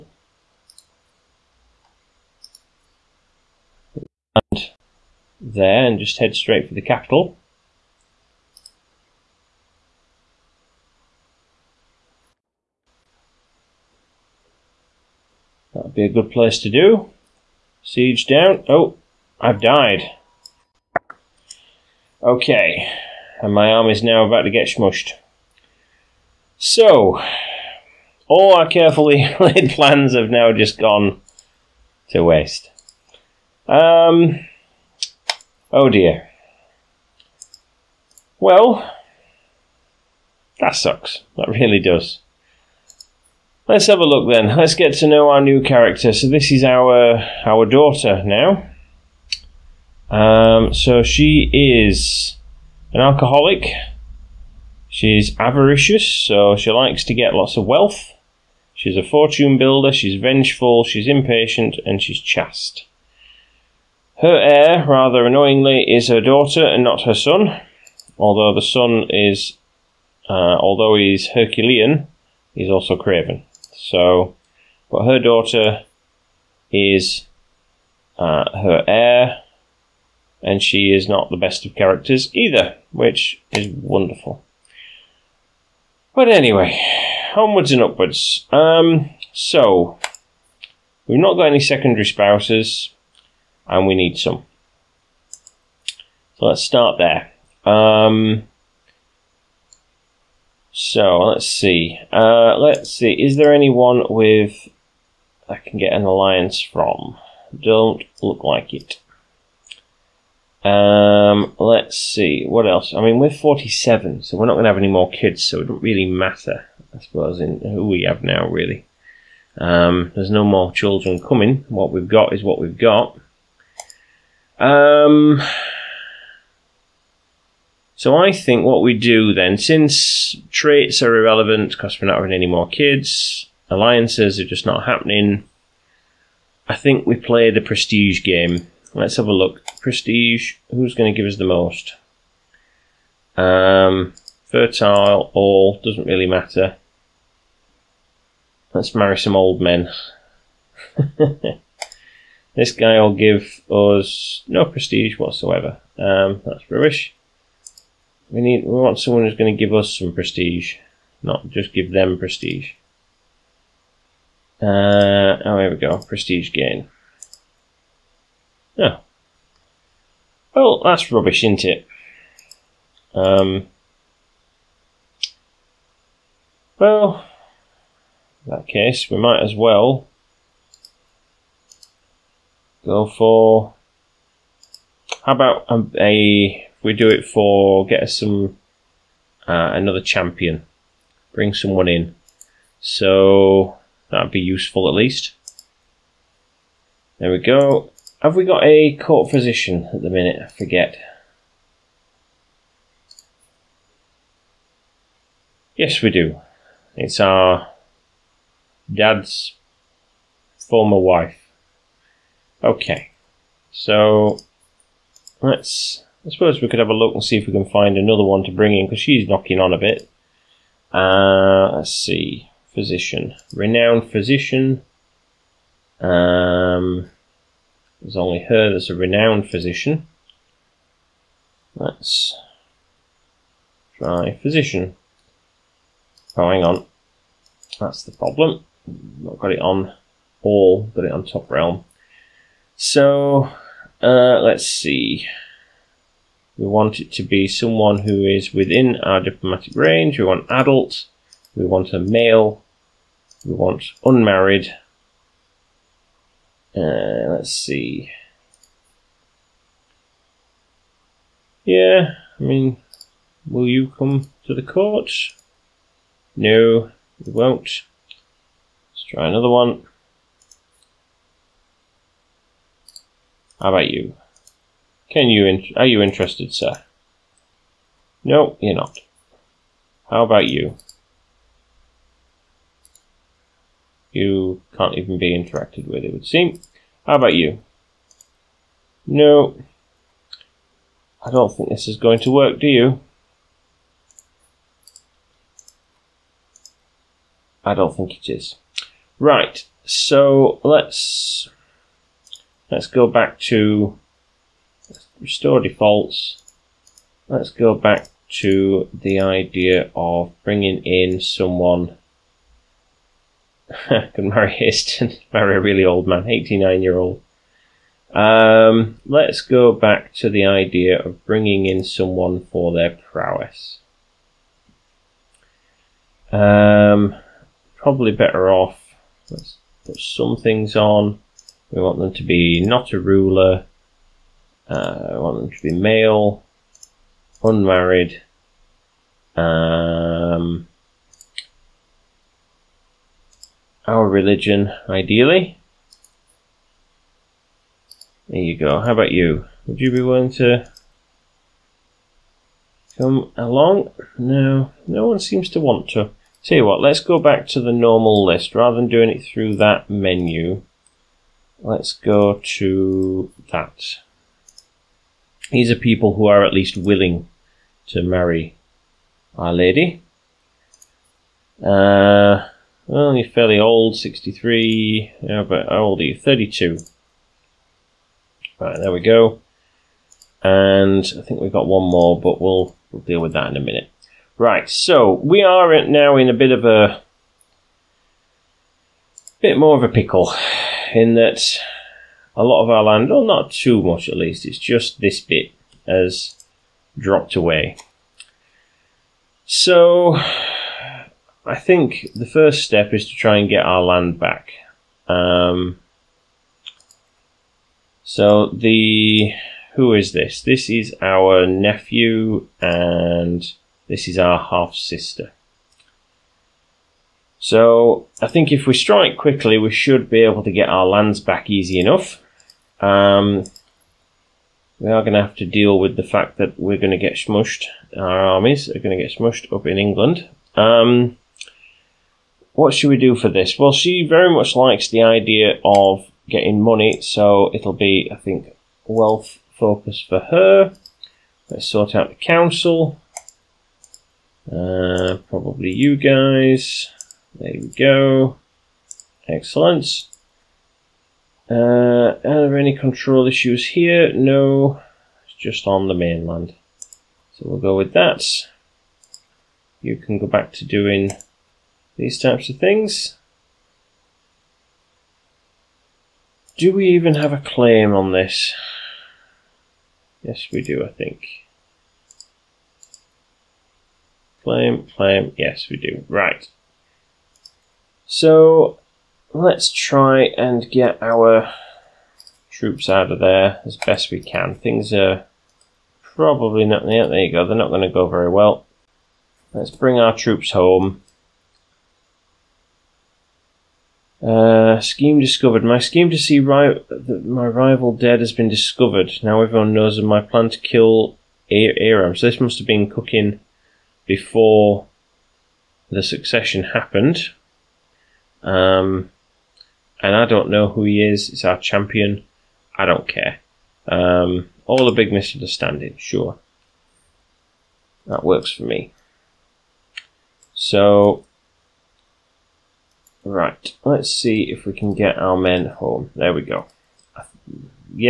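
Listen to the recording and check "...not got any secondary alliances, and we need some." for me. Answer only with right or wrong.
wrong.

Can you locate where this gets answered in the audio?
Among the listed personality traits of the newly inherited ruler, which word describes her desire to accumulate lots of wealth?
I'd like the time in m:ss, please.
0:55.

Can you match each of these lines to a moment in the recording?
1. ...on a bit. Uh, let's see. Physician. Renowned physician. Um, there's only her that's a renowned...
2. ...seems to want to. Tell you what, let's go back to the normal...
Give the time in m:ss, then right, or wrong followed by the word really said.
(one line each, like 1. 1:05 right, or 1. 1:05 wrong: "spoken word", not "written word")
1. 3:39 right
2. 5:55 right.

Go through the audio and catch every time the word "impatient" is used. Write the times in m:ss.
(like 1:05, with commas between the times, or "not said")
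1:01.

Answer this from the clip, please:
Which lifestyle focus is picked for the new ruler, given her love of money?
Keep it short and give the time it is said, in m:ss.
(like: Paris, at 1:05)
Wealth focus, at 7:18.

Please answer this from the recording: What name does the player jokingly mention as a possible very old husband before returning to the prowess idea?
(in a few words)
Hastings.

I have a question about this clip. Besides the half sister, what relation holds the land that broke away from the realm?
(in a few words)
Nephew.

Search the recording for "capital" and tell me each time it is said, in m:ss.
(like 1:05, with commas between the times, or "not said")
0:06.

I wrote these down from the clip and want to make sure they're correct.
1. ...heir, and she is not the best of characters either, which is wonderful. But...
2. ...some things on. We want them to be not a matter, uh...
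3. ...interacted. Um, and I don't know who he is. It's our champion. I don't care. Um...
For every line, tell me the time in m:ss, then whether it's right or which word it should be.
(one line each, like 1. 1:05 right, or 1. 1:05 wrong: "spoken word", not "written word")
1. 1:18 right
2. 5:29 wrong: "ruler", not "matter"
3. 8:26 wrong: "happened", not "interacted".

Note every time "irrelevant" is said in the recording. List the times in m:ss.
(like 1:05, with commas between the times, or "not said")
2:11.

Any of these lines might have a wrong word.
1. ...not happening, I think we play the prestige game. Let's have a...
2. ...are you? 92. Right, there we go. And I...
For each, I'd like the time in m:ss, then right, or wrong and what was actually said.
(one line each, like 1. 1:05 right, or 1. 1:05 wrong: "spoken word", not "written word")
1. 2:14 right
2. 6:15 wrong: "32", not "92".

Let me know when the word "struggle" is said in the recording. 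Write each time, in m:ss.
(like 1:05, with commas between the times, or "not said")
not said.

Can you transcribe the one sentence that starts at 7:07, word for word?
Our armies are going to get smushed up in England.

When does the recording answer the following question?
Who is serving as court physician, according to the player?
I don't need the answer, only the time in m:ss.
3:27.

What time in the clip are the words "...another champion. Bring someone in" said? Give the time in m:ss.
3:09.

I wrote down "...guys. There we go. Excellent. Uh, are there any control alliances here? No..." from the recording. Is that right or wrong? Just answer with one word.
wrong.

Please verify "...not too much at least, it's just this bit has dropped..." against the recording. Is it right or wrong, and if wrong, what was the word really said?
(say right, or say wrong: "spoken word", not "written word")
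right.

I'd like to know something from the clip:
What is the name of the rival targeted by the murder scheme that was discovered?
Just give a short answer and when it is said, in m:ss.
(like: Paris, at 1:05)
Aram, at 8:21.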